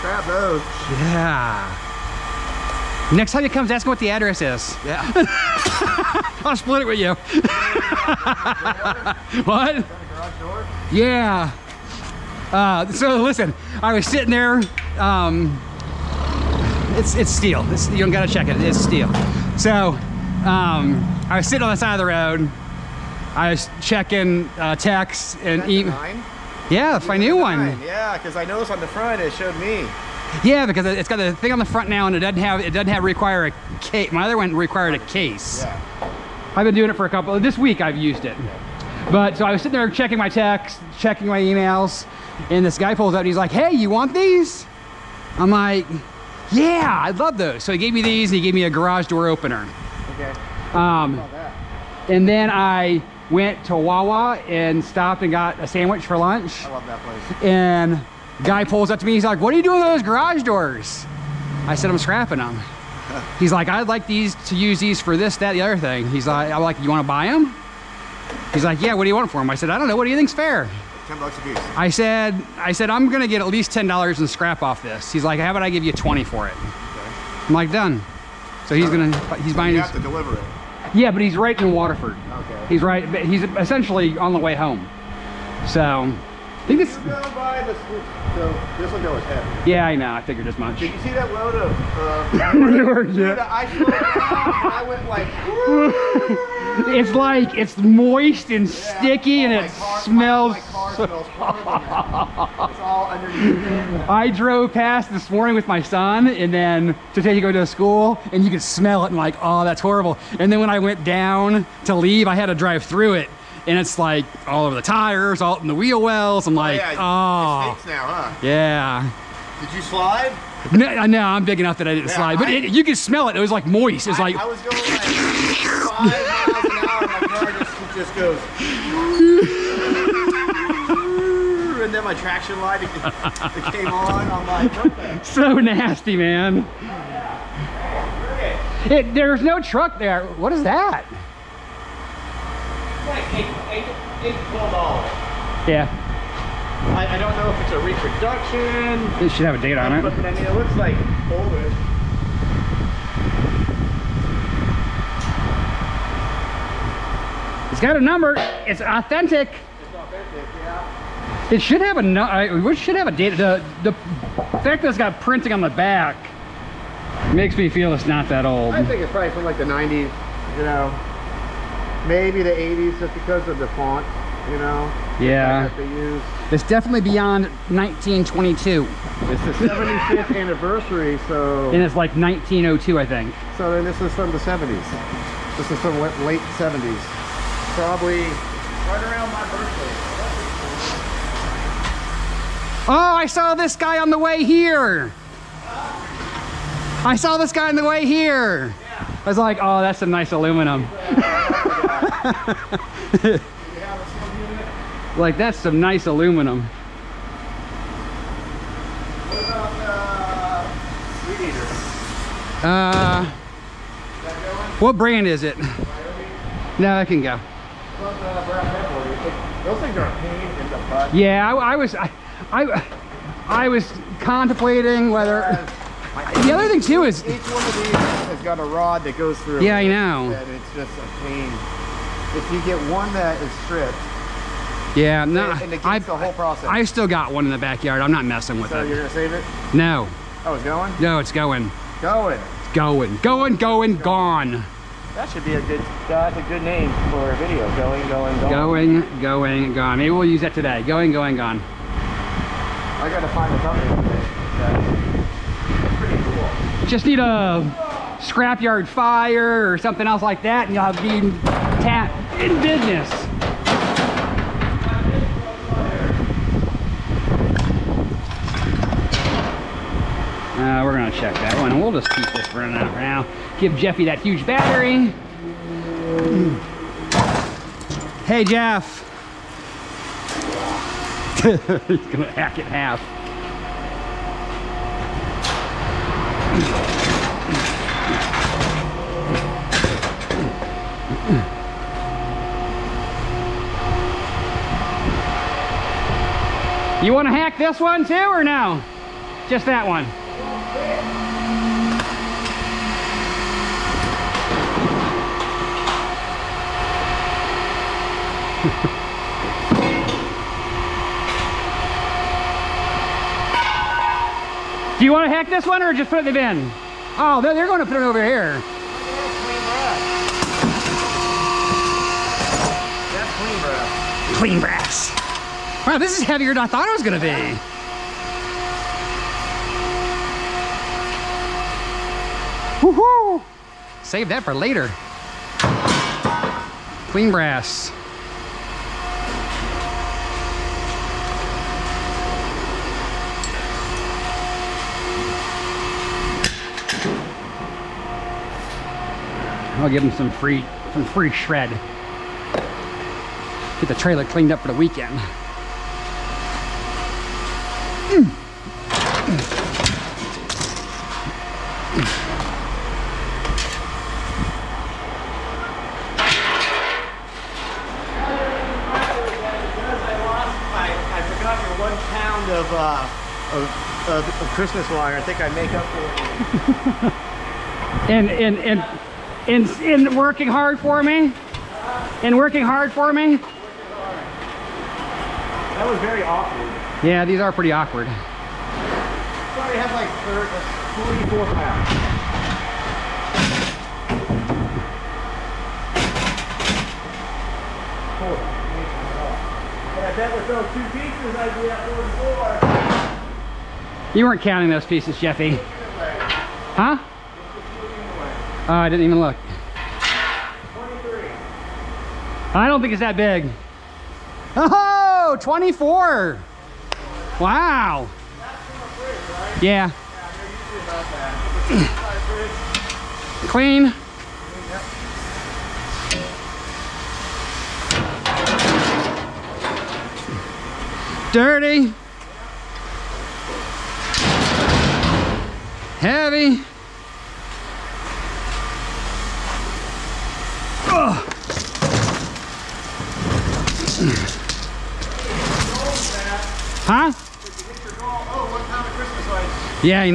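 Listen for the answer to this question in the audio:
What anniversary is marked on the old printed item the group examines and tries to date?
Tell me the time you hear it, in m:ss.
2:59.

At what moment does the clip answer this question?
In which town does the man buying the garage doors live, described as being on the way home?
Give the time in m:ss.
1:21.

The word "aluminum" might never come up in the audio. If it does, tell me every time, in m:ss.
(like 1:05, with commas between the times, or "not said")
3:20, 3:26.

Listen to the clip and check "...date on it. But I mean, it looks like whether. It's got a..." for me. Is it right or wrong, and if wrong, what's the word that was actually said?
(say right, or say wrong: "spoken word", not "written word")
wrong: "older", not "whether".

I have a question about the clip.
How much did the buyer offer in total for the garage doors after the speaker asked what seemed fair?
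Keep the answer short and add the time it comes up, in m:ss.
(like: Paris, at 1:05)
$20, at 1:15.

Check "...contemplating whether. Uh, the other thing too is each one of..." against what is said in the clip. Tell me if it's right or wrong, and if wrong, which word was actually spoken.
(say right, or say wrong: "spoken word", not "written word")
right.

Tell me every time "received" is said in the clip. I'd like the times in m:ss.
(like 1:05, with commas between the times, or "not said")
not said.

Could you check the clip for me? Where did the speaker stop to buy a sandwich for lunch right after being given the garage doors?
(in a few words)
Wawa.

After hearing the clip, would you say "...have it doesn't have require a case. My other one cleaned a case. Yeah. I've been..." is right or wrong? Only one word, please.
wrong.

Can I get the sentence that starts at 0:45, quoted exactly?
I'm like, yeah, I love those.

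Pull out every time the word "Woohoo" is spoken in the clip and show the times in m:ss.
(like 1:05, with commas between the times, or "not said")
5:32.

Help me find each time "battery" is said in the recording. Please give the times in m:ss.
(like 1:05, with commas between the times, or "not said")
4:34.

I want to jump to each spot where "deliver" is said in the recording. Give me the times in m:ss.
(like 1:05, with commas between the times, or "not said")
1:20.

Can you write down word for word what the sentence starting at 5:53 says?
Get the trailer cleaned up for the weekend.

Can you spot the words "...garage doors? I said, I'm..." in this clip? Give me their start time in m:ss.
1:00.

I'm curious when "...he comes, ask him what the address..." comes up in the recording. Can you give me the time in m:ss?
0:03.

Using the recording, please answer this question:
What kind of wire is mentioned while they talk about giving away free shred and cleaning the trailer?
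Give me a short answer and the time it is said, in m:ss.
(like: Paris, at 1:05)
Christmas wire, at 6:14.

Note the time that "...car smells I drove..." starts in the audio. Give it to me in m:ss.
1:42.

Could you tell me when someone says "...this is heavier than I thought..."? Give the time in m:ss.
5:25.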